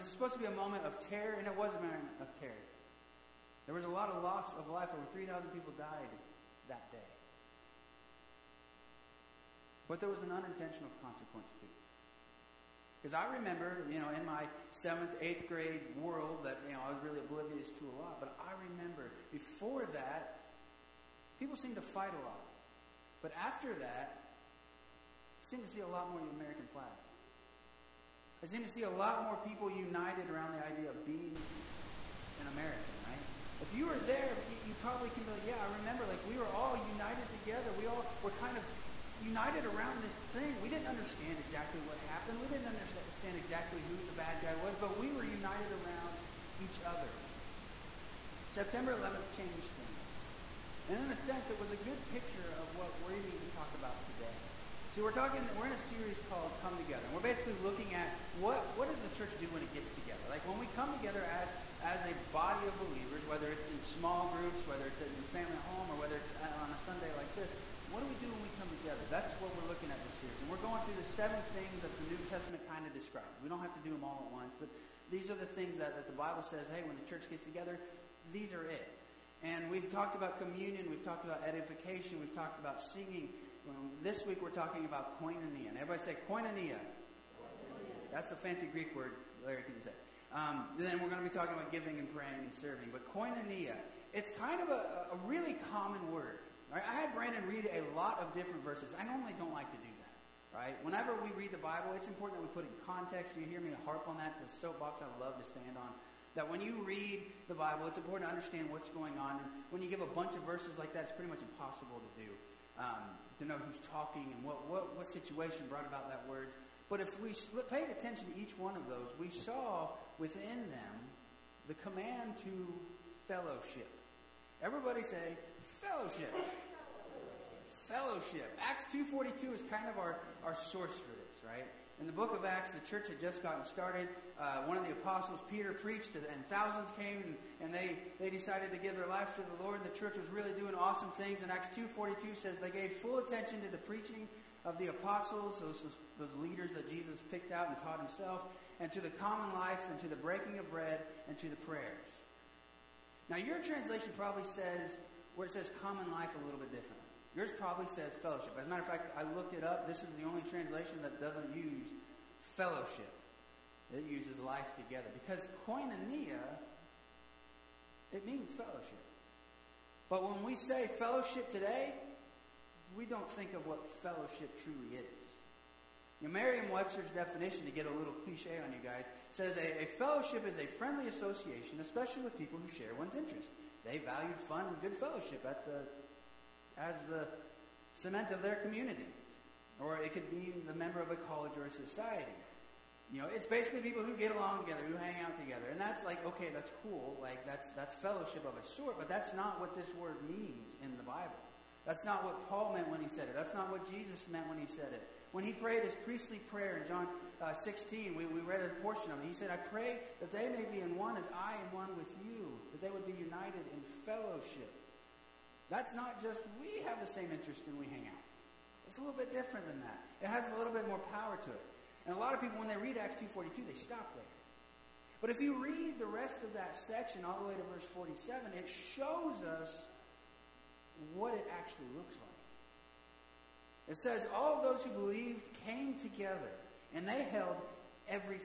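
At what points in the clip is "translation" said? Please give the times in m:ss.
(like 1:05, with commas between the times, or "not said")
2:33, 2:40.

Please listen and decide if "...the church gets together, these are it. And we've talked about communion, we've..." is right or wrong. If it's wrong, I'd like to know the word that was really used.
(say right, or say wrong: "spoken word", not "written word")
right.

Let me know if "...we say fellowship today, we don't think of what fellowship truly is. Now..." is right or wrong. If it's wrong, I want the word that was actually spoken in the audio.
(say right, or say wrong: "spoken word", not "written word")
right.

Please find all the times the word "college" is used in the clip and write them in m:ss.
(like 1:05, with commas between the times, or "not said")
3:11.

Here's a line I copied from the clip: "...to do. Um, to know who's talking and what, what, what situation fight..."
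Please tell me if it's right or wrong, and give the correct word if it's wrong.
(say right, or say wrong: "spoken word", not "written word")
wrong: "brought", not "fight".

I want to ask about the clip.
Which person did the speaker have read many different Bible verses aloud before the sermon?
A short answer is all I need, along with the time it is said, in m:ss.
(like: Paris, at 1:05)
Brandon, at 1:37.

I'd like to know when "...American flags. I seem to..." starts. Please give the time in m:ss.
0:26.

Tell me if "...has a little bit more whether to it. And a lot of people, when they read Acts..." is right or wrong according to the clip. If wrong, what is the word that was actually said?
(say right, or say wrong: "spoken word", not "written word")
wrong: "power", not "whether".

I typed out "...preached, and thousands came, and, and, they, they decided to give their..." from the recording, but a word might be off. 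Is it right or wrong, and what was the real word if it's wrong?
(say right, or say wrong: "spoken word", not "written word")
right.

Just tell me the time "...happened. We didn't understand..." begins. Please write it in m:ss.
0:42.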